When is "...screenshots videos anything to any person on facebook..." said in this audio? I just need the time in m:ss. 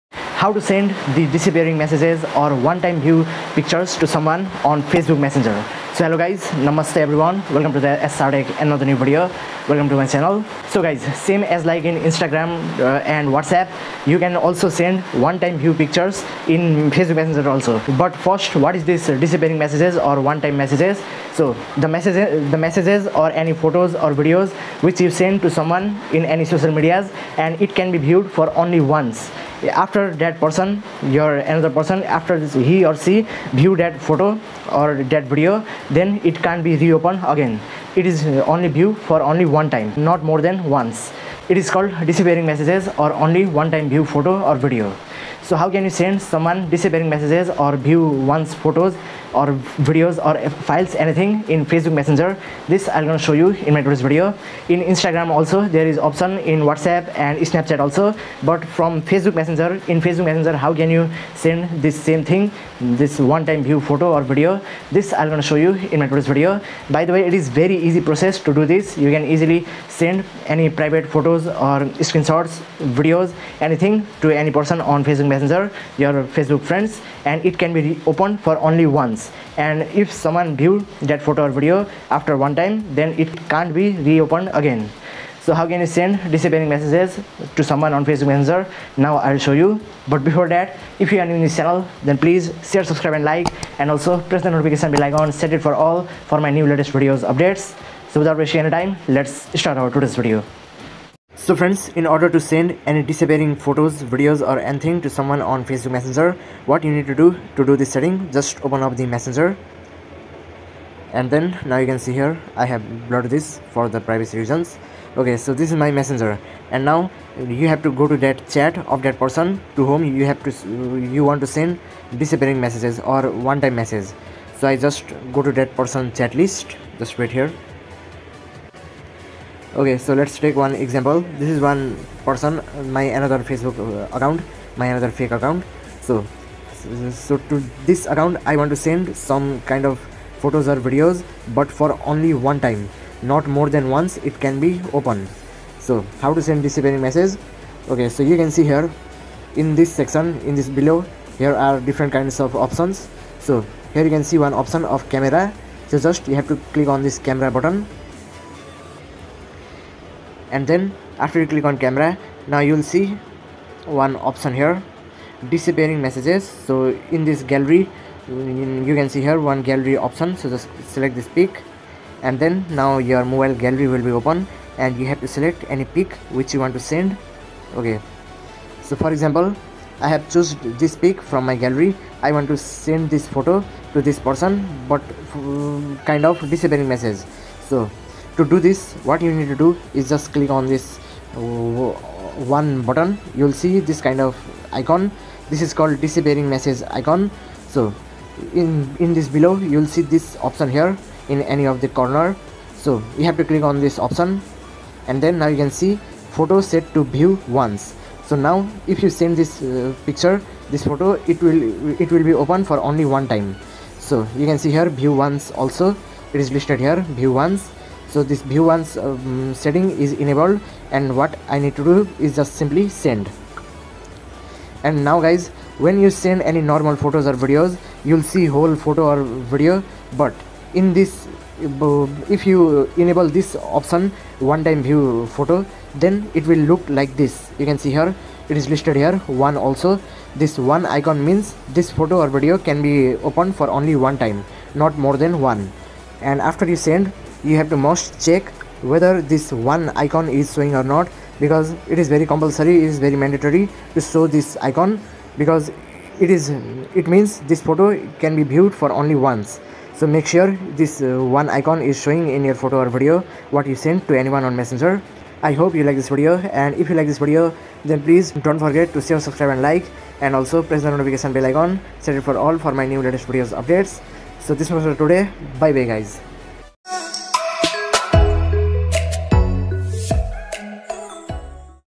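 1:12.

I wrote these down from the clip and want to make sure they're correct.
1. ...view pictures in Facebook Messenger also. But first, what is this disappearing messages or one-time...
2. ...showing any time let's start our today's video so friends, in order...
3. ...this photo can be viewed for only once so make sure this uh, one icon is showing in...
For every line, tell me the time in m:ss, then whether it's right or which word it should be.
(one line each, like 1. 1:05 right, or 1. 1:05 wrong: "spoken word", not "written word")
1. 0:15 right
2. 1:38 wrong: "wasting", not "showing"
3. 4:17 right.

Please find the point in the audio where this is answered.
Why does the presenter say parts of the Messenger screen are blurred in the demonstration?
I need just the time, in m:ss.
1:53.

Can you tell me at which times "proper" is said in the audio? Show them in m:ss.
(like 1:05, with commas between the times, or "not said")
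not said.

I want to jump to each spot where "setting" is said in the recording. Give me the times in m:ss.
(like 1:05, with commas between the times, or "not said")
1:47, 3:39.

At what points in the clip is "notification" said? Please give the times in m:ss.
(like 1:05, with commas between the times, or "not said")
1:34, 4:30.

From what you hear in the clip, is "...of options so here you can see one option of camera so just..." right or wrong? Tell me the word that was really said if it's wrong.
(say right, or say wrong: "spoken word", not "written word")
right.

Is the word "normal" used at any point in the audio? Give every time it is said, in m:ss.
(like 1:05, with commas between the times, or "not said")
3:46.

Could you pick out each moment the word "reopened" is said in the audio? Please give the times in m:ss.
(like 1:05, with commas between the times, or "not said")
0:36, 1:24.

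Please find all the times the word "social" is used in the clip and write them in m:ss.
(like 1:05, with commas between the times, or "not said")
0:26.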